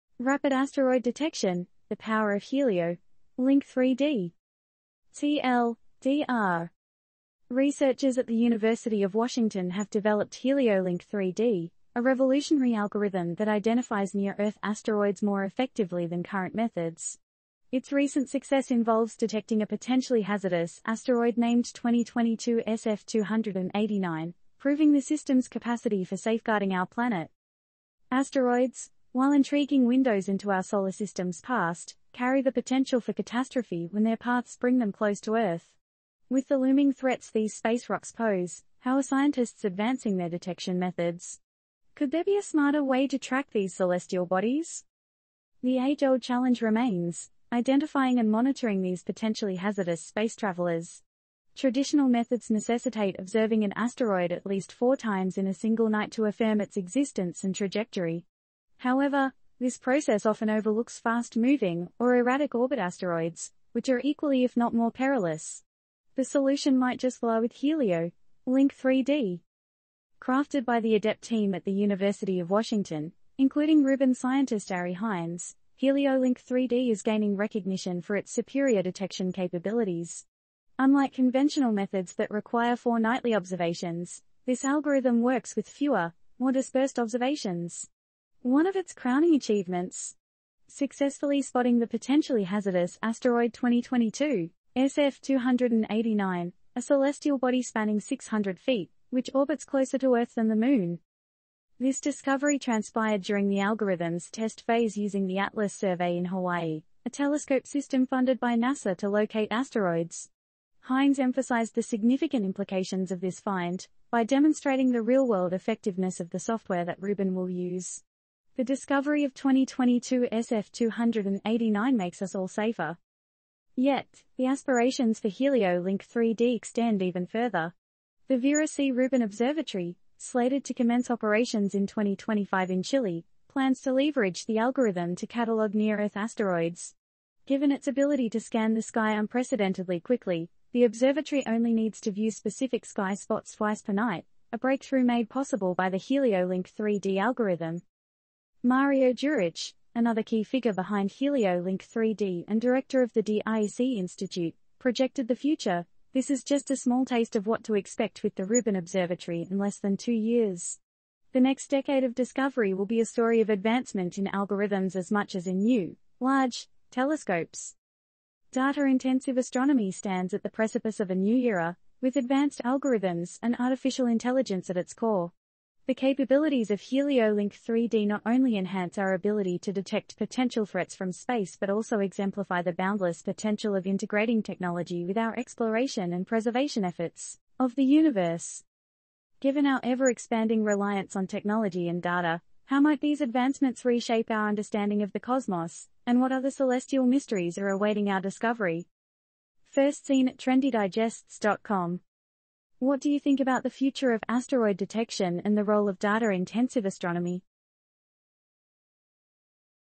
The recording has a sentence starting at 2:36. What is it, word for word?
This is just a small taste of what to expect with the Rubin Observatory in less than two years.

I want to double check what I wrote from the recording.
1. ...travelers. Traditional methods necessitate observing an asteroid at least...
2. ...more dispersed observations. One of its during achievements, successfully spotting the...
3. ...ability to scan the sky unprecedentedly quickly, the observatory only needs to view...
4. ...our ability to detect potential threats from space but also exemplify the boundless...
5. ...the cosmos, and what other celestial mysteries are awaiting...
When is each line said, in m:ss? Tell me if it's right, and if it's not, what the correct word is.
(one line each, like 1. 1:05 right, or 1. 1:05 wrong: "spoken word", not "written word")
1. 0:50 right
2. 1:26 wrong: "crowning", not "during"
3. 2:17 right
4. 2:58 right
5. 3:15 right.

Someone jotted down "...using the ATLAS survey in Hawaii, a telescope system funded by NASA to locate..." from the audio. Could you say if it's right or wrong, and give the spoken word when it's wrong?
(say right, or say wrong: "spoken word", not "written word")
right.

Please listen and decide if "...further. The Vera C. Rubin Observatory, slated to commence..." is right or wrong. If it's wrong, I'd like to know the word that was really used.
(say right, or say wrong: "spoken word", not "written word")
right.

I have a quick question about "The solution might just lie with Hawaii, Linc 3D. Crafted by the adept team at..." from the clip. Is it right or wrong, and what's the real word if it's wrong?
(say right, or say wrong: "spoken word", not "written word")
wrong: "Helio", not "Hawaii".